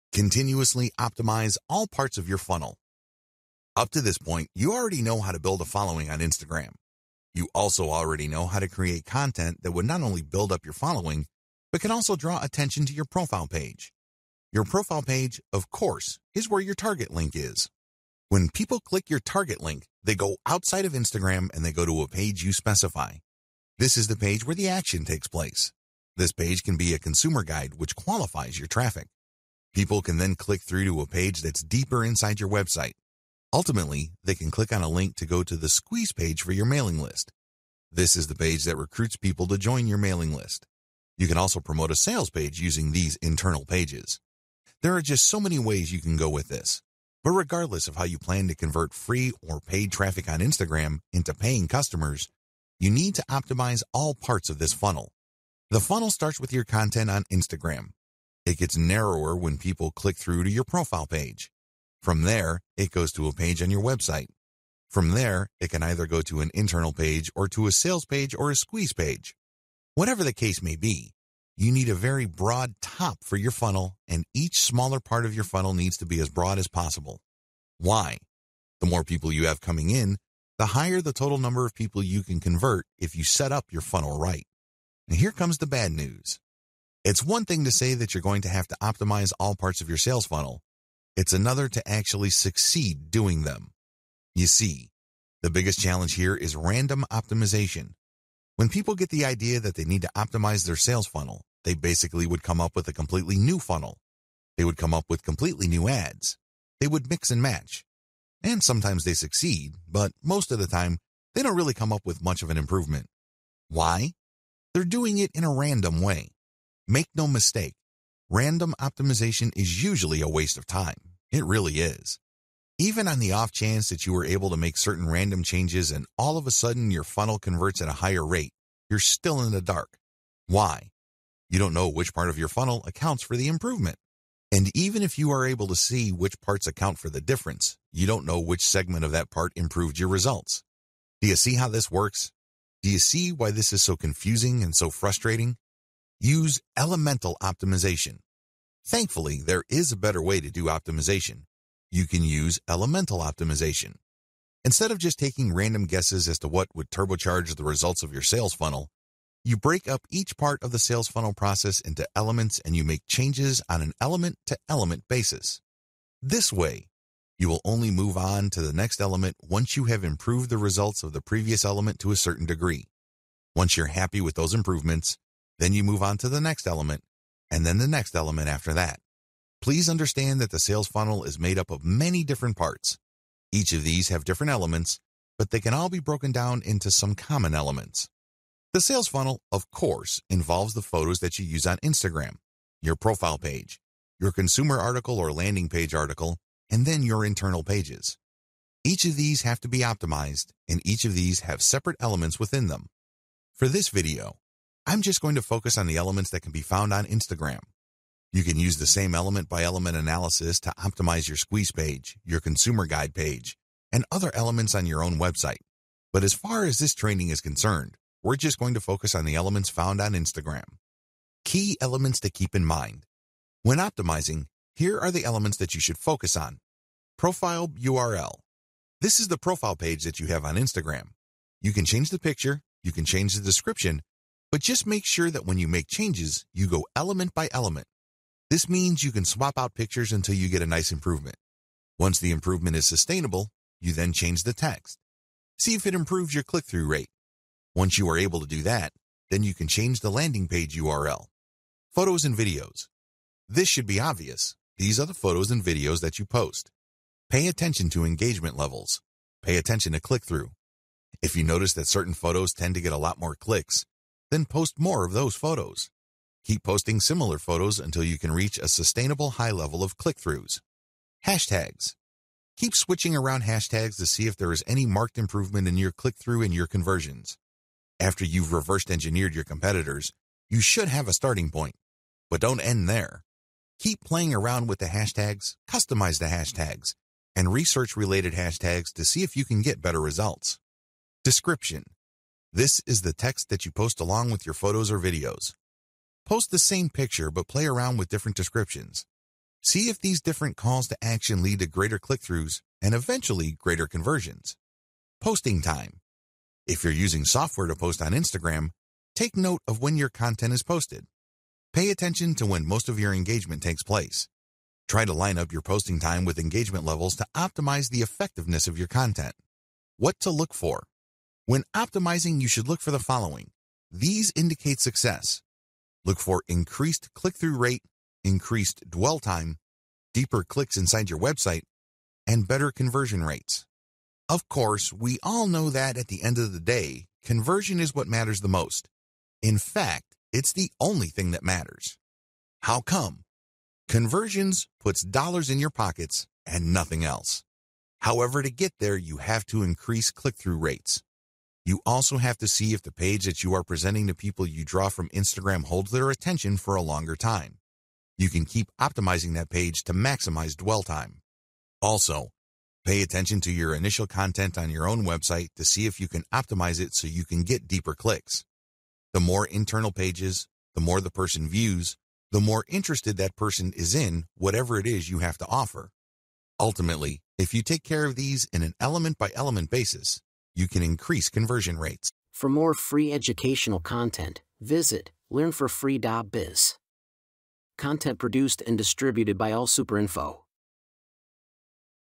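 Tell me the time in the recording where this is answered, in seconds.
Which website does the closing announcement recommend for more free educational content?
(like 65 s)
385 s.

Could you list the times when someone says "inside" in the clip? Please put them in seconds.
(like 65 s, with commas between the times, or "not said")
32 s, 330 s.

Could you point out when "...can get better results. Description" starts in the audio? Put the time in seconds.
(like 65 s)
289 s.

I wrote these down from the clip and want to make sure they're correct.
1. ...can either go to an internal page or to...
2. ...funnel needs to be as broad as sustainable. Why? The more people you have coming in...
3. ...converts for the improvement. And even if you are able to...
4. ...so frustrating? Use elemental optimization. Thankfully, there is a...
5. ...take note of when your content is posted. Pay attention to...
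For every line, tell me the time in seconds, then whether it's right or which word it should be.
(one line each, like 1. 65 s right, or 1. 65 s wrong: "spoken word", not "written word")
1. 65 s right
2. 75 s wrong: "possible", not "sustainable"
3. 132 s wrong: "accounts", not "converts"
4. 144 s right
5. 309 s right.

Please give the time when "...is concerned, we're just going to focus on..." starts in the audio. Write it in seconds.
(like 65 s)
217 s.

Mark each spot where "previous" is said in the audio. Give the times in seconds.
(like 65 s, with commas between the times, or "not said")
171 s.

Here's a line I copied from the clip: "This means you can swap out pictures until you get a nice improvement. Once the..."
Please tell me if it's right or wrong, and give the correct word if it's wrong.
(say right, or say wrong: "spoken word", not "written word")
right.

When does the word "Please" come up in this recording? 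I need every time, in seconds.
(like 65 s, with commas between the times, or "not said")
179 s.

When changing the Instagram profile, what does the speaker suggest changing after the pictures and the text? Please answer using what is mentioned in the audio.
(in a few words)
landing page URL.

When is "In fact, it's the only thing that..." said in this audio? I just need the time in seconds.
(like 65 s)
339 s.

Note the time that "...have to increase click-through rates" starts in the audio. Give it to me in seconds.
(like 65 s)
349 s.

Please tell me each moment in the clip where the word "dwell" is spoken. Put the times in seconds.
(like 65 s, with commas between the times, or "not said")
328 s, 360 s.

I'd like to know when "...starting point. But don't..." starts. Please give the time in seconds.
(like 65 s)
281 s.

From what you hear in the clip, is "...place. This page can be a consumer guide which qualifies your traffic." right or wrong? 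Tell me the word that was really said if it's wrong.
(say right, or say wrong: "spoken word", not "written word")
right.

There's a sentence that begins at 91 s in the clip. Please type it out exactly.
It's another to actually succeed doing them.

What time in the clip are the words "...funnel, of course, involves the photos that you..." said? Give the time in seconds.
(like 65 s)
189 s.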